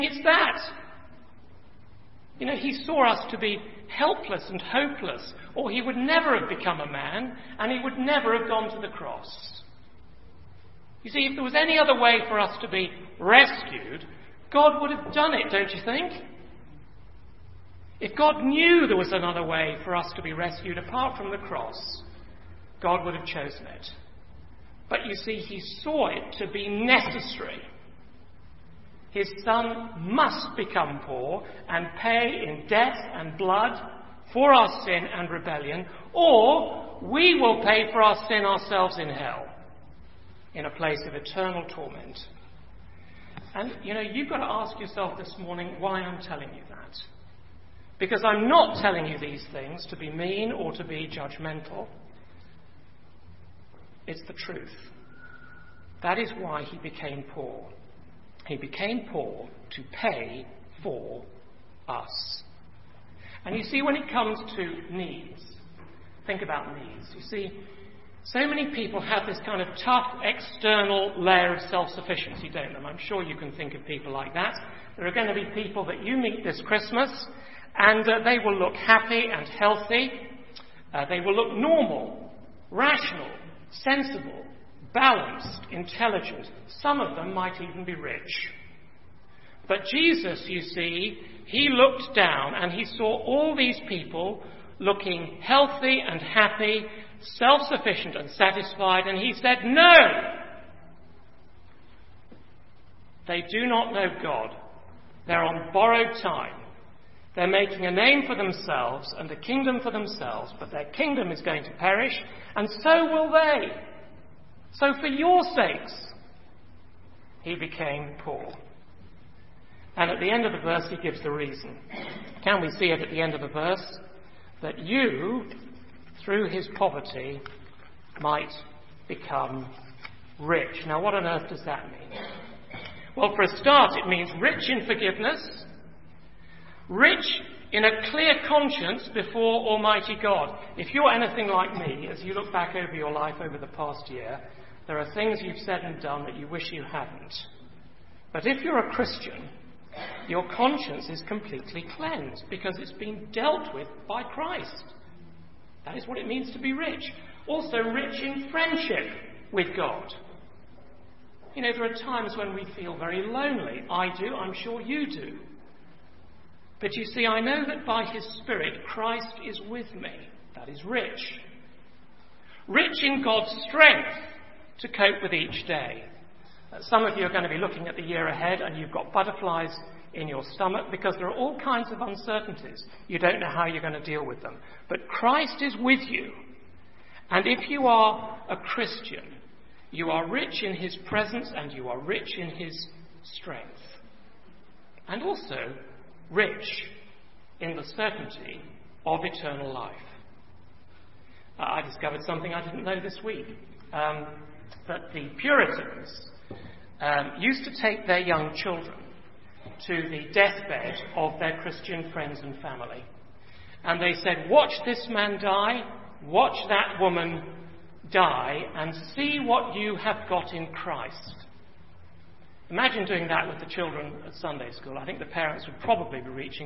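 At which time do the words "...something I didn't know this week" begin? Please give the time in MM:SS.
03:22.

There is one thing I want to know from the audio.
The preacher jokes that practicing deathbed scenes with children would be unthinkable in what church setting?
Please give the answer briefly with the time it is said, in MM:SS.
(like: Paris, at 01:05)
Sunday school, at 03:44.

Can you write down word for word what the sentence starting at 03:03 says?
You don't know how you're going to deal with them.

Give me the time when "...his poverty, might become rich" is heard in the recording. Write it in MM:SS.
02:06.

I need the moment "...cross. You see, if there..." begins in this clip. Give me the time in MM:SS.
00:08.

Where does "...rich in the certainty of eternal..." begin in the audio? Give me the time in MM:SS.
03:16.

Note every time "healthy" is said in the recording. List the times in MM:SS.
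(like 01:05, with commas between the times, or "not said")
01:19, 01:35.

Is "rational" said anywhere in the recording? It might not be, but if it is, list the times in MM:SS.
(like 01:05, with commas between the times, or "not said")
01:22.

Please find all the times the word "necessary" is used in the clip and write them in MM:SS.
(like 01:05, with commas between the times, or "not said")
00:26.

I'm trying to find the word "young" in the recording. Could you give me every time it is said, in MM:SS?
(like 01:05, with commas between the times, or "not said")
03:28.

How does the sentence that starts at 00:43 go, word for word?
And you know, you've got to ask yourself this morning why I'm telling you that.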